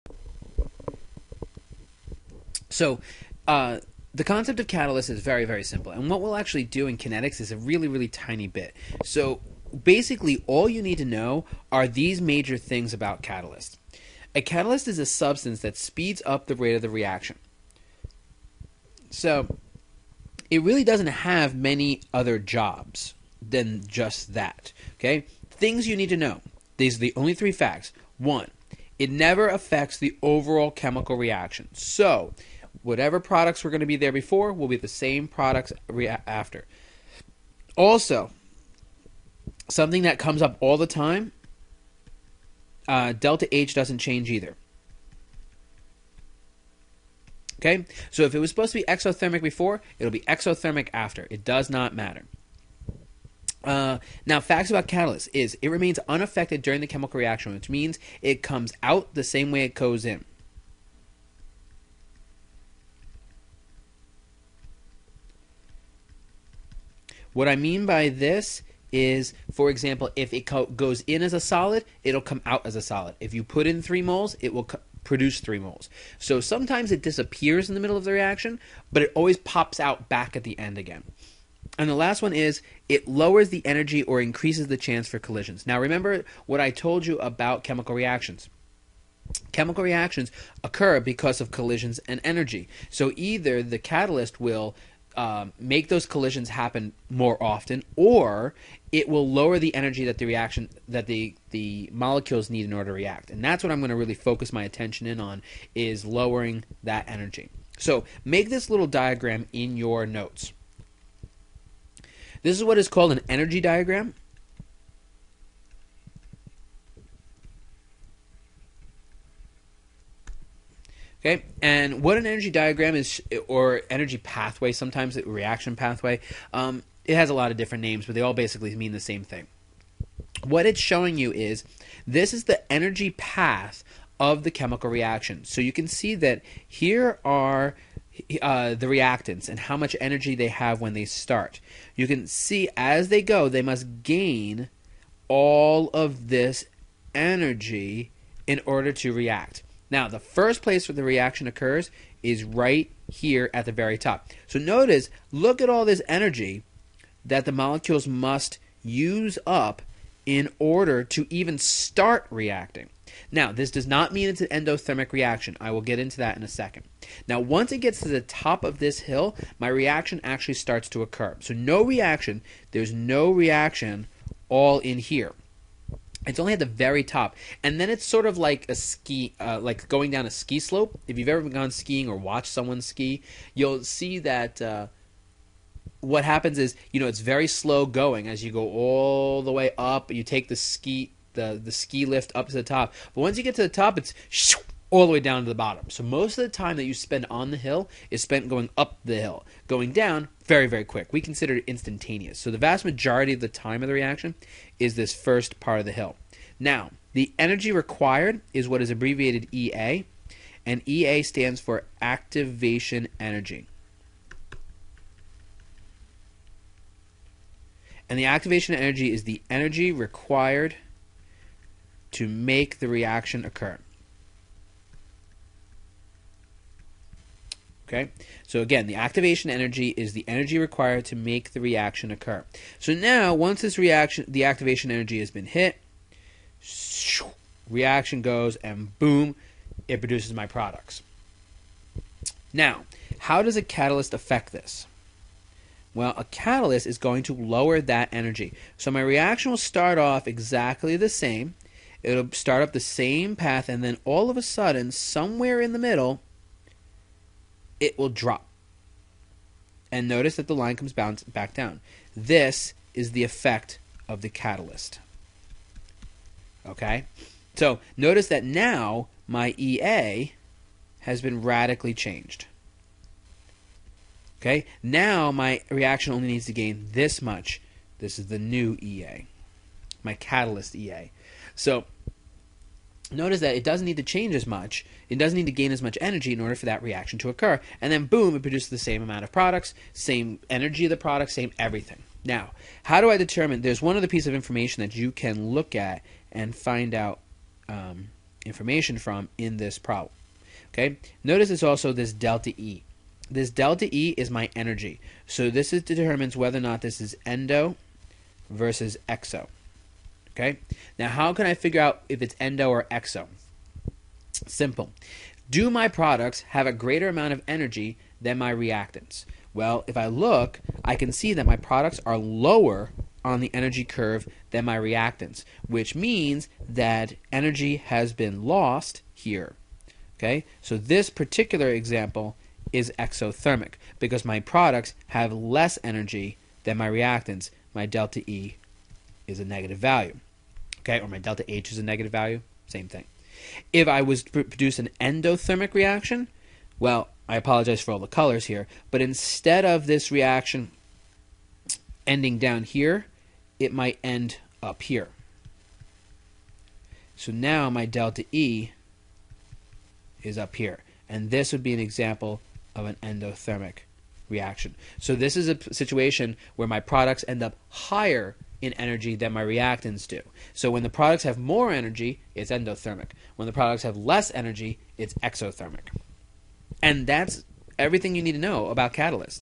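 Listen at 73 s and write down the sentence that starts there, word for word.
If you put in 3 moles, it will produce 3 moles.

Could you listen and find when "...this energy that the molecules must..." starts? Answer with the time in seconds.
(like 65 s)
155 s.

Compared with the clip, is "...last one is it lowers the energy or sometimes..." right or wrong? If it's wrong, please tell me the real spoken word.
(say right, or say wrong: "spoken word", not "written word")
wrong: "increases", not "sometimes".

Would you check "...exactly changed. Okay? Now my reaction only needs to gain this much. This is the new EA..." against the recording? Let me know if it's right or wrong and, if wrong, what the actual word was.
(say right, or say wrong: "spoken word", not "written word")
wrong: "radically", not "exactly".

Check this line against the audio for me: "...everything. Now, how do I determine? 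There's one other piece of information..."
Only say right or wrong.
right.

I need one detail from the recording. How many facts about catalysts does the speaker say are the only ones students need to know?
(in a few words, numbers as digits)
3.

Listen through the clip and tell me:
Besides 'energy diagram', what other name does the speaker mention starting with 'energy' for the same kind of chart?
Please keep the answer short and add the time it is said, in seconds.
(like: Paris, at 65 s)
Energy pathway, at 123 s.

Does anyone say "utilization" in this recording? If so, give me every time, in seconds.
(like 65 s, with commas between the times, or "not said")
not said.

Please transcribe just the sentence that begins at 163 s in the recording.
Now, this does not mean it's an endothermic reaction.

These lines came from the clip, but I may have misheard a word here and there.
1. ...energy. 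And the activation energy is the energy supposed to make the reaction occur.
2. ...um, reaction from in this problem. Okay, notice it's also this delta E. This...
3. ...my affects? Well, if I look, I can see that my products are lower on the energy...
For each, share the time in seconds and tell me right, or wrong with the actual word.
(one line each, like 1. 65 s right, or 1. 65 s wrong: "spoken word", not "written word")
1. 213 s wrong: "required", not "supposed"
2. 297 s wrong: "information", not "reaction"
3. 318 s wrong: "reactants", not "affects".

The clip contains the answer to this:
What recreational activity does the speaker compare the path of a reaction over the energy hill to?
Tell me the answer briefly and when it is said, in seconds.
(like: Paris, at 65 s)
Skiing, at 181 s.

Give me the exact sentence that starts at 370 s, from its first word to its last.
So when the products have more energy, it's endothermic.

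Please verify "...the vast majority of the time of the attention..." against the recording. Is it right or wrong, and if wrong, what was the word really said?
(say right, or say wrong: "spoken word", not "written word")
wrong: "reaction", not "attention".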